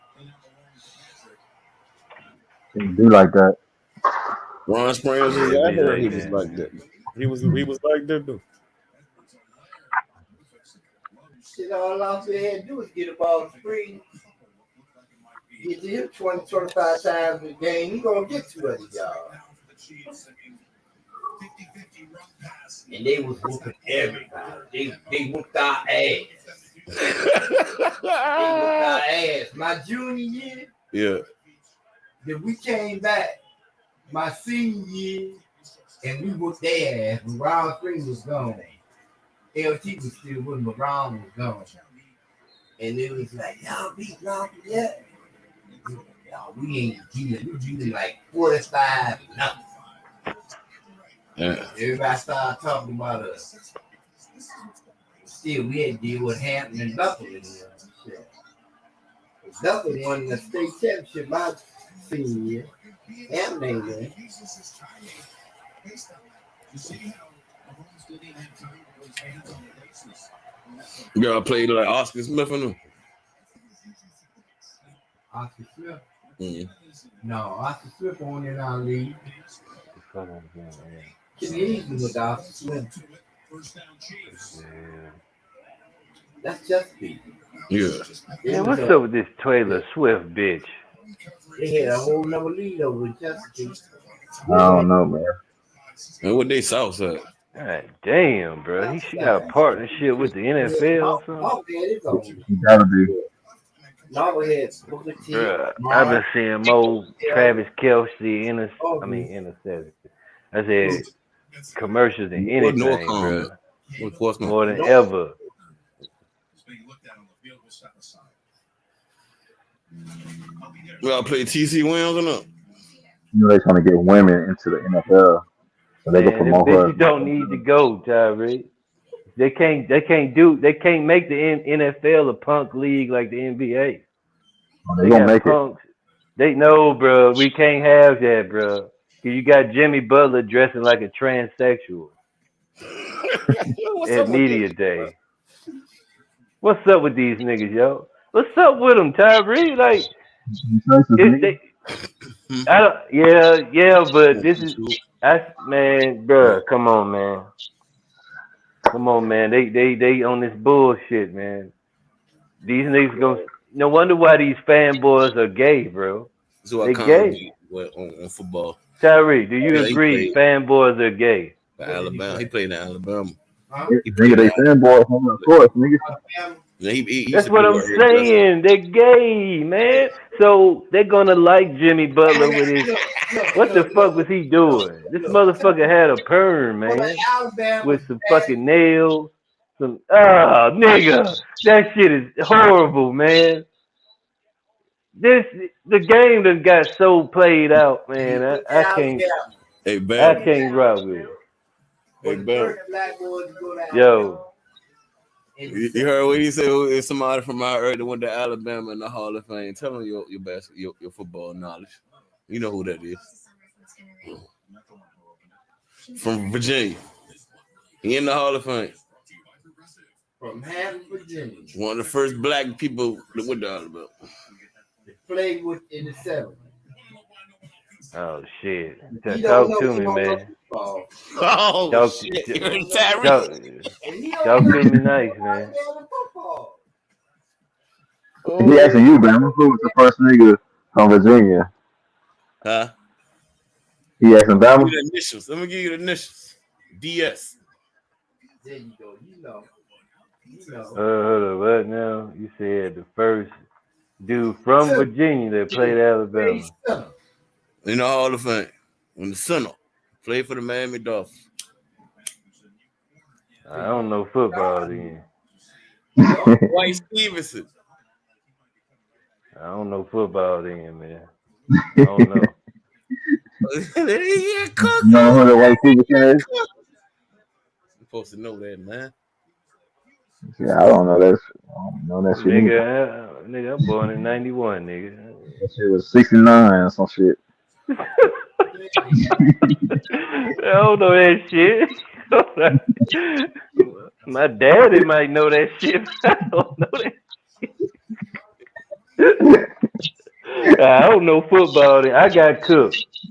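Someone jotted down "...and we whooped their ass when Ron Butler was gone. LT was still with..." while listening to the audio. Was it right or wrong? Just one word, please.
wrong.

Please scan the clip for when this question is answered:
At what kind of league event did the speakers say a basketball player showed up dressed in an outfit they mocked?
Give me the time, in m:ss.
2:24.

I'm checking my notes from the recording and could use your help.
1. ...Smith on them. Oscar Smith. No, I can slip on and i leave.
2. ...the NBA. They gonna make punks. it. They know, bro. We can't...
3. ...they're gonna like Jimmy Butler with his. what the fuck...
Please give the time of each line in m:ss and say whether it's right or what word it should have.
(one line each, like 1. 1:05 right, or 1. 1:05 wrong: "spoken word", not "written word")
1. 1:12 right
2. 2:13 right
3. 3:00 right.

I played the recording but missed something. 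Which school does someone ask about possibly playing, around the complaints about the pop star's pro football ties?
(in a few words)
TC Williams.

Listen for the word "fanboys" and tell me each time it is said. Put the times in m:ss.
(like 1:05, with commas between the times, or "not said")
2:44, 2:50, 2:54.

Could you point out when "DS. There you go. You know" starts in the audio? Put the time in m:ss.
4:06.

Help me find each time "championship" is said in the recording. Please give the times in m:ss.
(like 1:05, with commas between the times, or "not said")
1:00.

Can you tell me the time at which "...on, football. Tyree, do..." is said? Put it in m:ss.
2:48.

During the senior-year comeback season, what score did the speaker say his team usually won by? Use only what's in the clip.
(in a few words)
45-0.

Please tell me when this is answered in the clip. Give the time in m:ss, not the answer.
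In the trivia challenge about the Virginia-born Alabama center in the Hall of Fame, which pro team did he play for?
4:20.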